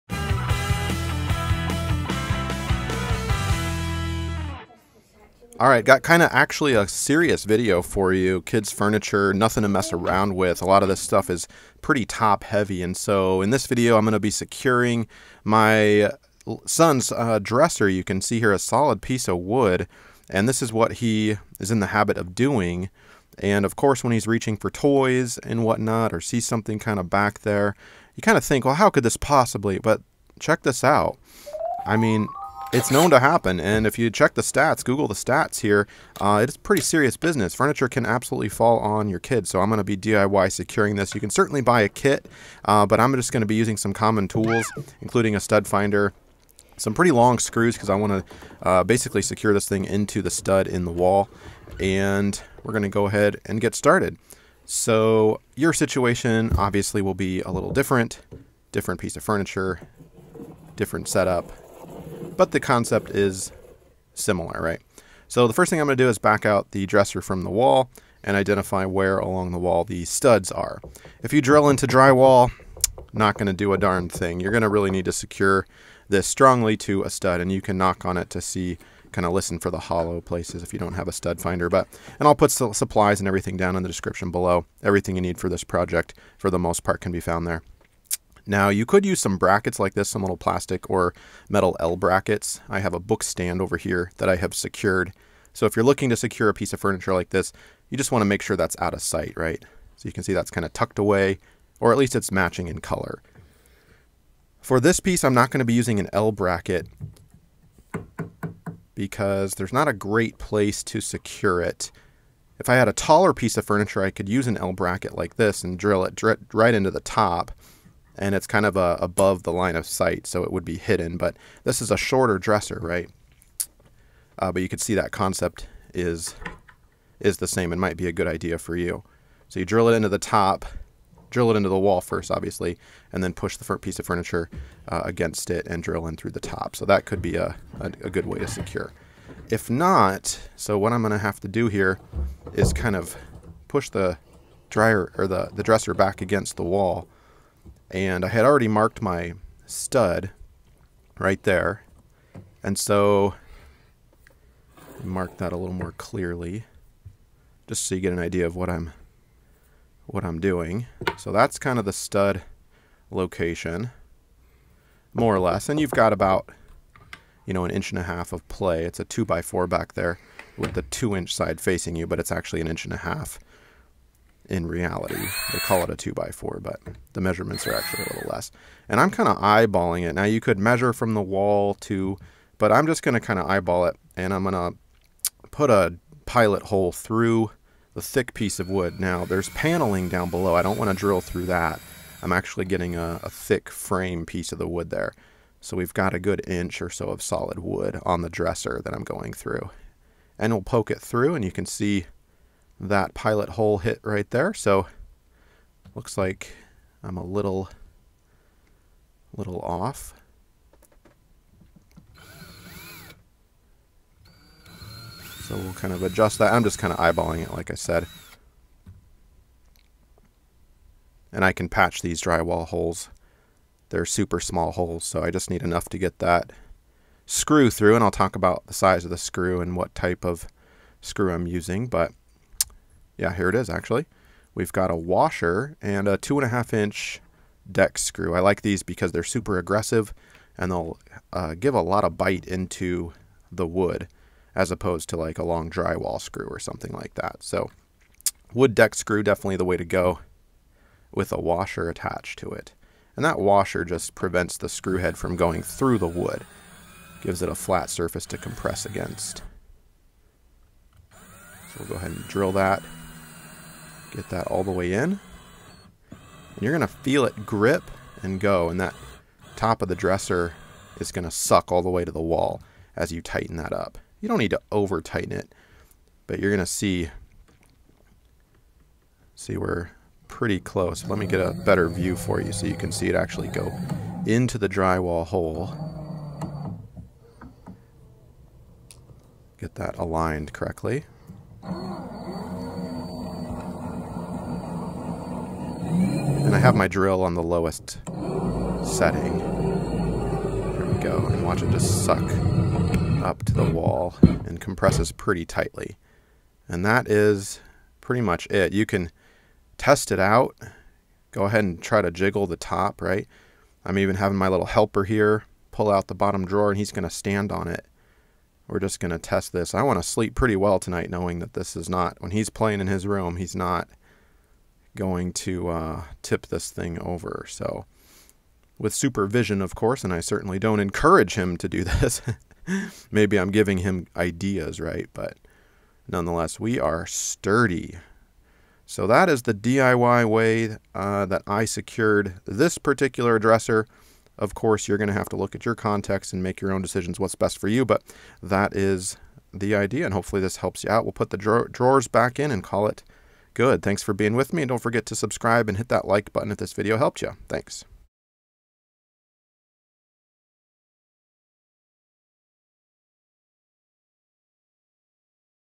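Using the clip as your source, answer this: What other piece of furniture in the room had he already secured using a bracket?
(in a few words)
book stand.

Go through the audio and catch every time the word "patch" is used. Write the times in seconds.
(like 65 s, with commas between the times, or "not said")
221 s.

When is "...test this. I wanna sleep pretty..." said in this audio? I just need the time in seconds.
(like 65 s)
319 s.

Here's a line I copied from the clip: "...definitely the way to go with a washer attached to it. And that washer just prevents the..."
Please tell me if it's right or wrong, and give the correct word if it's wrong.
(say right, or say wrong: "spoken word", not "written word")
right.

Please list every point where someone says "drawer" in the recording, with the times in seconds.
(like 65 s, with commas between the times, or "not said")
316 s, 351 s.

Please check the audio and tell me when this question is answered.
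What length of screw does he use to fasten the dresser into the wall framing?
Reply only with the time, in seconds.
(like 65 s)
236 s.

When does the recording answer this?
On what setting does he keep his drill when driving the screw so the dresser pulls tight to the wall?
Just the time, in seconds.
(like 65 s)
297 s.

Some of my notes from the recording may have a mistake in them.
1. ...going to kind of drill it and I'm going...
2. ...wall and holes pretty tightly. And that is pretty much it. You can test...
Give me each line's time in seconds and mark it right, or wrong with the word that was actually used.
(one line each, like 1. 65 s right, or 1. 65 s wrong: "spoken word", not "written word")
1. 183 s wrong: "eyeball", not "drill"
2. 303 s wrong: "compresses", not "holes".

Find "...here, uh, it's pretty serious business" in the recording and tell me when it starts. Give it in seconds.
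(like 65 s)
35 s.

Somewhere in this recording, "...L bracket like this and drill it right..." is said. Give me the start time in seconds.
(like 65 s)
114 s.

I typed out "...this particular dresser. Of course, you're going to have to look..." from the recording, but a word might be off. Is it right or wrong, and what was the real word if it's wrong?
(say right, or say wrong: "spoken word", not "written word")
right.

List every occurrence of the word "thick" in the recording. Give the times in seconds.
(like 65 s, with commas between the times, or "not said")
188 s, 193 s.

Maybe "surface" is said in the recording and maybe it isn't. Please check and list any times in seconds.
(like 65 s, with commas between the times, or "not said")
257 s.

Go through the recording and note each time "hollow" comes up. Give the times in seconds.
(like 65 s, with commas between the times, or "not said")
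79 s.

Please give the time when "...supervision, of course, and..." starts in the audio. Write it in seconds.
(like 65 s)
328 s.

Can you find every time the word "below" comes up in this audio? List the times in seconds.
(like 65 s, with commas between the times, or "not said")
84 s, 190 s.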